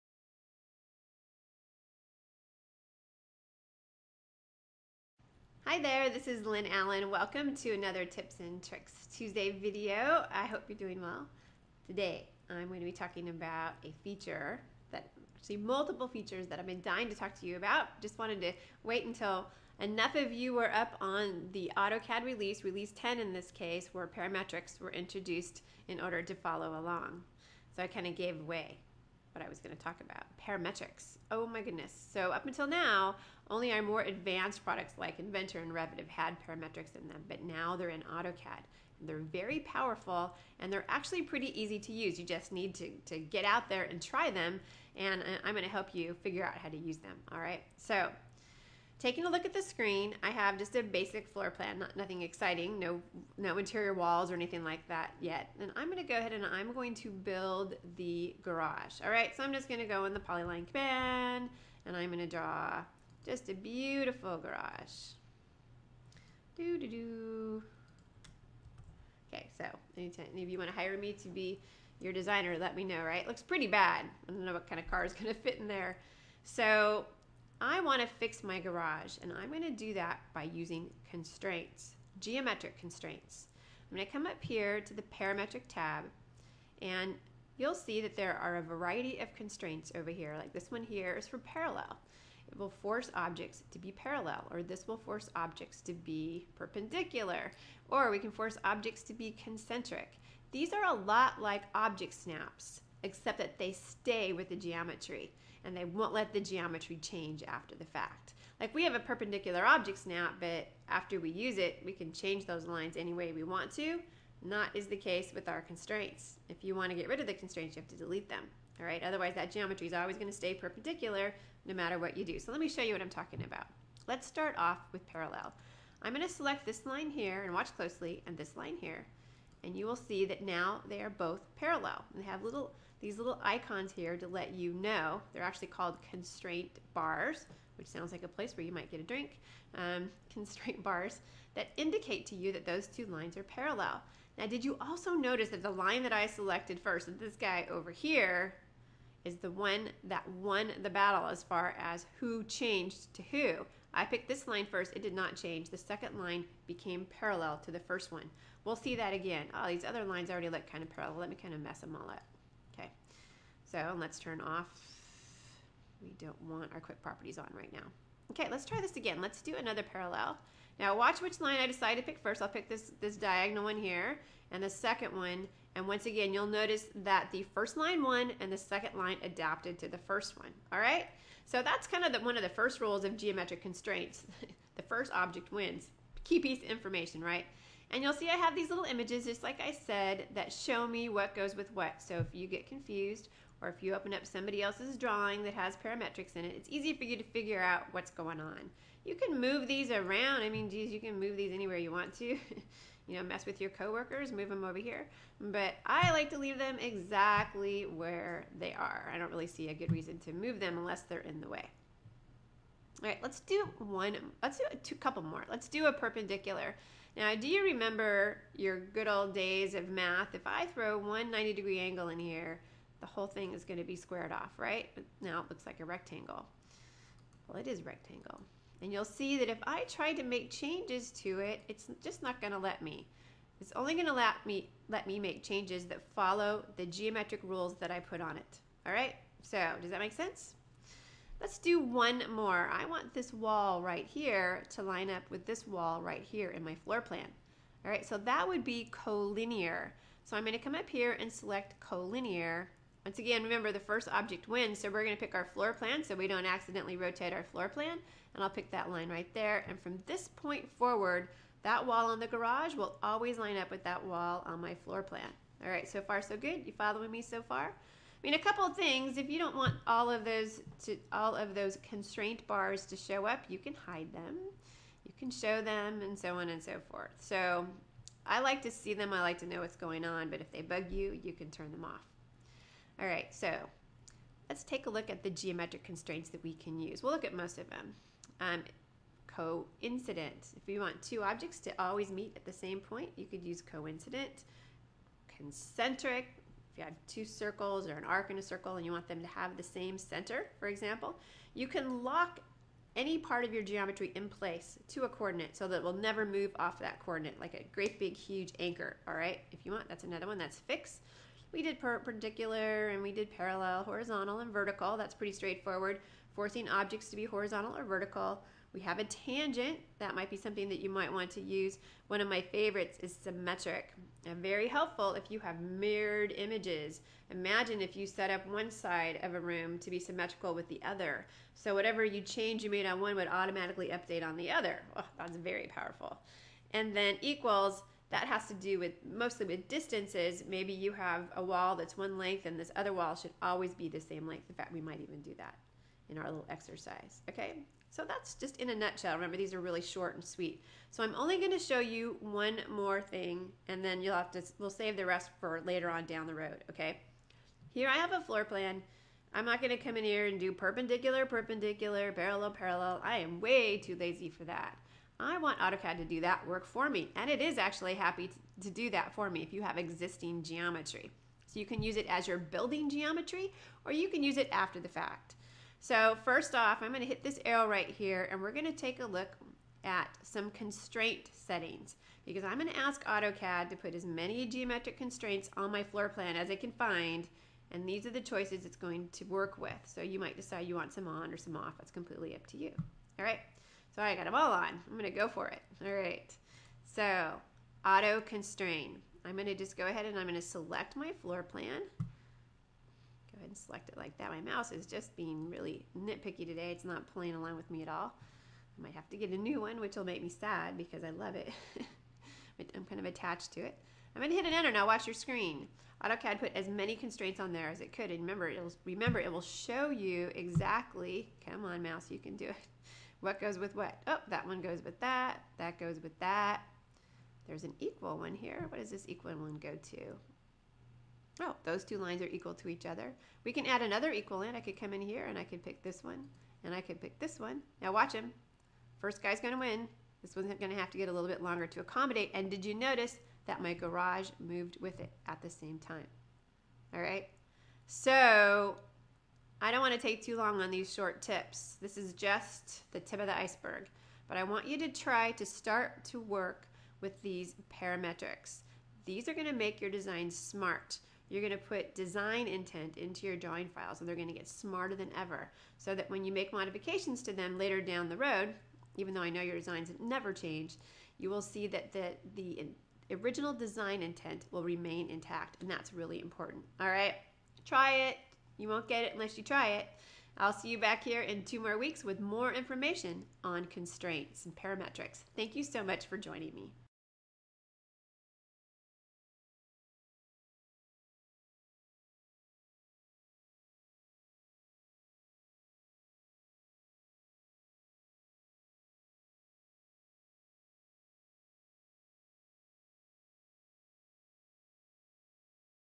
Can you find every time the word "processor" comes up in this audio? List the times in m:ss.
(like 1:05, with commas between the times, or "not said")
not said.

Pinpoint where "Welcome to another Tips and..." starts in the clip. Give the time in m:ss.
0:07.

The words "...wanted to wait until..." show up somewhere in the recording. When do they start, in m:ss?
0:18.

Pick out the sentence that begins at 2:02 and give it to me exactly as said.
So let me show you what I'm talking about.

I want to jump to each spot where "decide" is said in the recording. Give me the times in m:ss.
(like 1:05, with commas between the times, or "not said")
2:51, 6:30.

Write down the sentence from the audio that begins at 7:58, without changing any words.
You won't get it unless you try it.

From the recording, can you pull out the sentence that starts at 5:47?
So that's just in a nutshell.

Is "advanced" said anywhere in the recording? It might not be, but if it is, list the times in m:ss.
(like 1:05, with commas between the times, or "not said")
0:34.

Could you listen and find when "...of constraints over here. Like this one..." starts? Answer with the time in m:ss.
1:29.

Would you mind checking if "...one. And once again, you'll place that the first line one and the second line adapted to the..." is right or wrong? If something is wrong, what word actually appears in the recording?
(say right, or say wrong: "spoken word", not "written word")
wrong: "notice", not "place".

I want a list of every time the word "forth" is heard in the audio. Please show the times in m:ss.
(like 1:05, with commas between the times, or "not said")
4:36.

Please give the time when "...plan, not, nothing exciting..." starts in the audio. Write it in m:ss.
0:51.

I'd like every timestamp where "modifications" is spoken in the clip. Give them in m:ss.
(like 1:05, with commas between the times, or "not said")
7:46.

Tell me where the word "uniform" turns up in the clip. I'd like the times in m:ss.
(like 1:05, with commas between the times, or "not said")
not said.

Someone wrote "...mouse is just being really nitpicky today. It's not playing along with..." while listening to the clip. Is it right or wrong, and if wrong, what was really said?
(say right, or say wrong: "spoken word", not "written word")
right.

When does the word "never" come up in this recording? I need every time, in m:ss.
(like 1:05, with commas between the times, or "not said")
5:05, 7:49.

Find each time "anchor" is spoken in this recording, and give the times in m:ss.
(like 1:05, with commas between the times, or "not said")
5:08.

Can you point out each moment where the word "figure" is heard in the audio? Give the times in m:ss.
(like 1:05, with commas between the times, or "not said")
0:46, 3:17.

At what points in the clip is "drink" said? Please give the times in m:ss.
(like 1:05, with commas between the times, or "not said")
2:19.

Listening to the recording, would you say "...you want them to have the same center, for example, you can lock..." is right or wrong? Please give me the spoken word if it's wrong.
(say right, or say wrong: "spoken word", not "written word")
right.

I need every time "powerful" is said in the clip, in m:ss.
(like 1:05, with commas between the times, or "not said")
0:39, 5:35.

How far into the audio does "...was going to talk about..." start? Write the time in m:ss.
0:29.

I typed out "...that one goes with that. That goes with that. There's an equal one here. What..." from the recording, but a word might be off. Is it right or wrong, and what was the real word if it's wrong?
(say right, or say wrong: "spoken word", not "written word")
right.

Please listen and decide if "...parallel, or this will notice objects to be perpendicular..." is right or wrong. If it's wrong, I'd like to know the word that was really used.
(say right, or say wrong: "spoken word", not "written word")
wrong: "force", not "notice".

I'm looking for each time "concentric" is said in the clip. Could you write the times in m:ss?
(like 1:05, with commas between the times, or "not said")
1:39, 4:55.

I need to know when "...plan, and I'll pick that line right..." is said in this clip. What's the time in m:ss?
4:17.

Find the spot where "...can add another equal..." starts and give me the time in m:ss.
7:13.